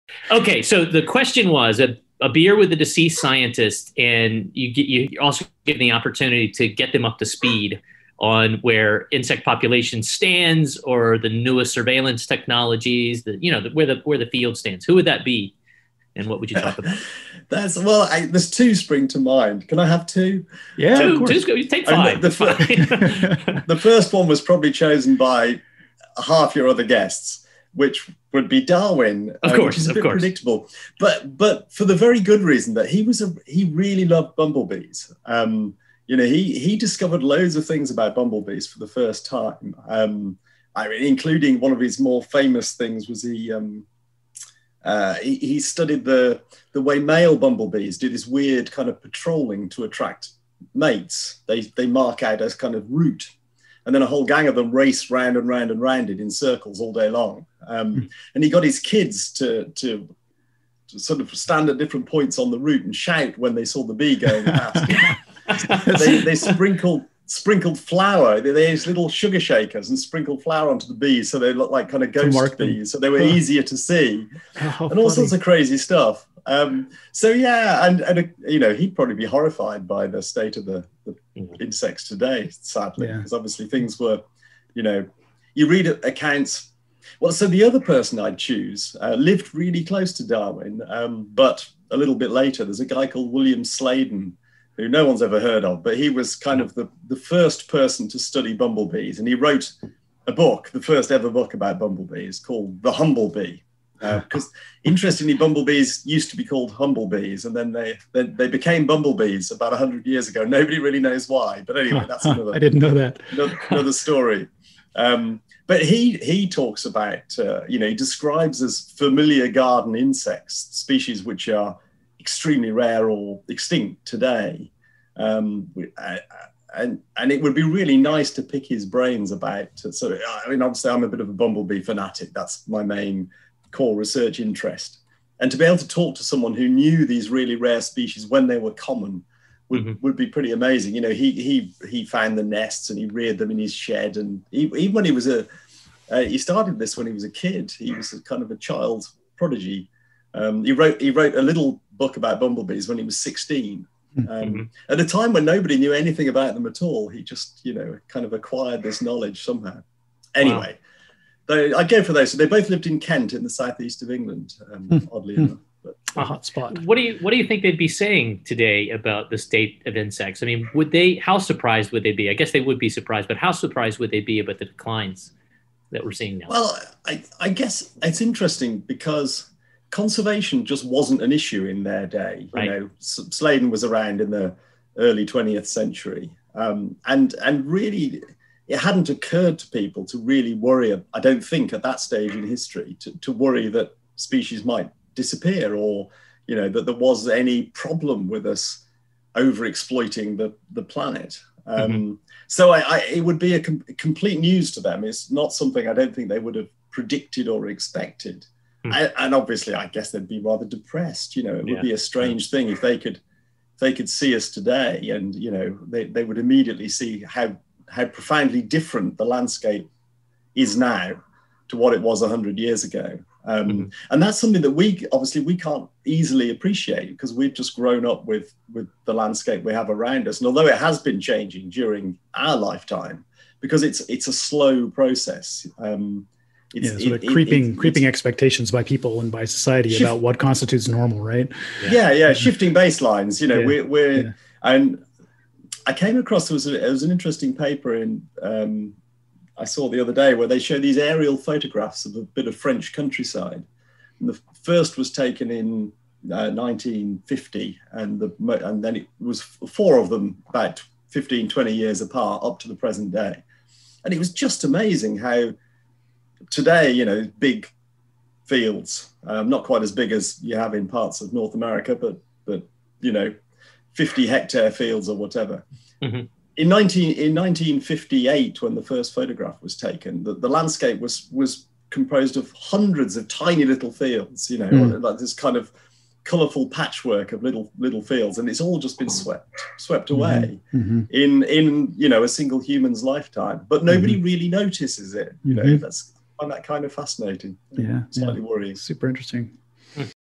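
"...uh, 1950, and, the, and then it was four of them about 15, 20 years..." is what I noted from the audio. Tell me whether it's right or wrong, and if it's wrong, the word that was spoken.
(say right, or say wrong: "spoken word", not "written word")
right.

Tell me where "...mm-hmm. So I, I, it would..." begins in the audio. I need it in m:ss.
3:21.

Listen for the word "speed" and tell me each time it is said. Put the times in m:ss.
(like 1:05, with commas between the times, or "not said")
0:07.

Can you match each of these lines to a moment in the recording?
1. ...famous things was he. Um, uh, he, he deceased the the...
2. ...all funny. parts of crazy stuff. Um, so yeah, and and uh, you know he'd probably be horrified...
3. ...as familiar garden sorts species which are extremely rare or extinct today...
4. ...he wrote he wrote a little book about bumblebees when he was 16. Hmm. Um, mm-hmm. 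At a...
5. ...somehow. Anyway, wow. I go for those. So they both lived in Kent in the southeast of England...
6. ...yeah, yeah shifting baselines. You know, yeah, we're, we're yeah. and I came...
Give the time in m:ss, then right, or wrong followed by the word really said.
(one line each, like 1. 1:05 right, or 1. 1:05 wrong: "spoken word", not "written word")
1. 0:42 wrong: "studied", not "deceased"
2. 1:14 wrong: "sorts", not "parts"
3. 1:58 wrong: "insects", not "sorts"
4. 2:30 right
5. 2:39 right
6. 4:02 right.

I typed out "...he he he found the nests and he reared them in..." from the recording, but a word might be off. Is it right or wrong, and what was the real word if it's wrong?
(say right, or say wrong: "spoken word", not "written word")
right.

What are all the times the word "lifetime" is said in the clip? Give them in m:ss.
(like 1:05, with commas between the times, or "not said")
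3:52, 4:53.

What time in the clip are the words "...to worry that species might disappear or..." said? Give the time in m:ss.
3:13.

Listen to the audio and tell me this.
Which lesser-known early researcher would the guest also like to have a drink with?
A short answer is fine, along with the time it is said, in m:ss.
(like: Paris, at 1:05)
William Sladen, at 1:33.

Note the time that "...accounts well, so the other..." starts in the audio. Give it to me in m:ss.
1:26.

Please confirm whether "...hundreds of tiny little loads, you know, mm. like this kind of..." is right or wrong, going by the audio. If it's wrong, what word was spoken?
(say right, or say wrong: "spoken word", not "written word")
wrong: "fields", not "loads".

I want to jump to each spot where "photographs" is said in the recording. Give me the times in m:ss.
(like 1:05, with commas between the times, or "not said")
4:11, 4:39.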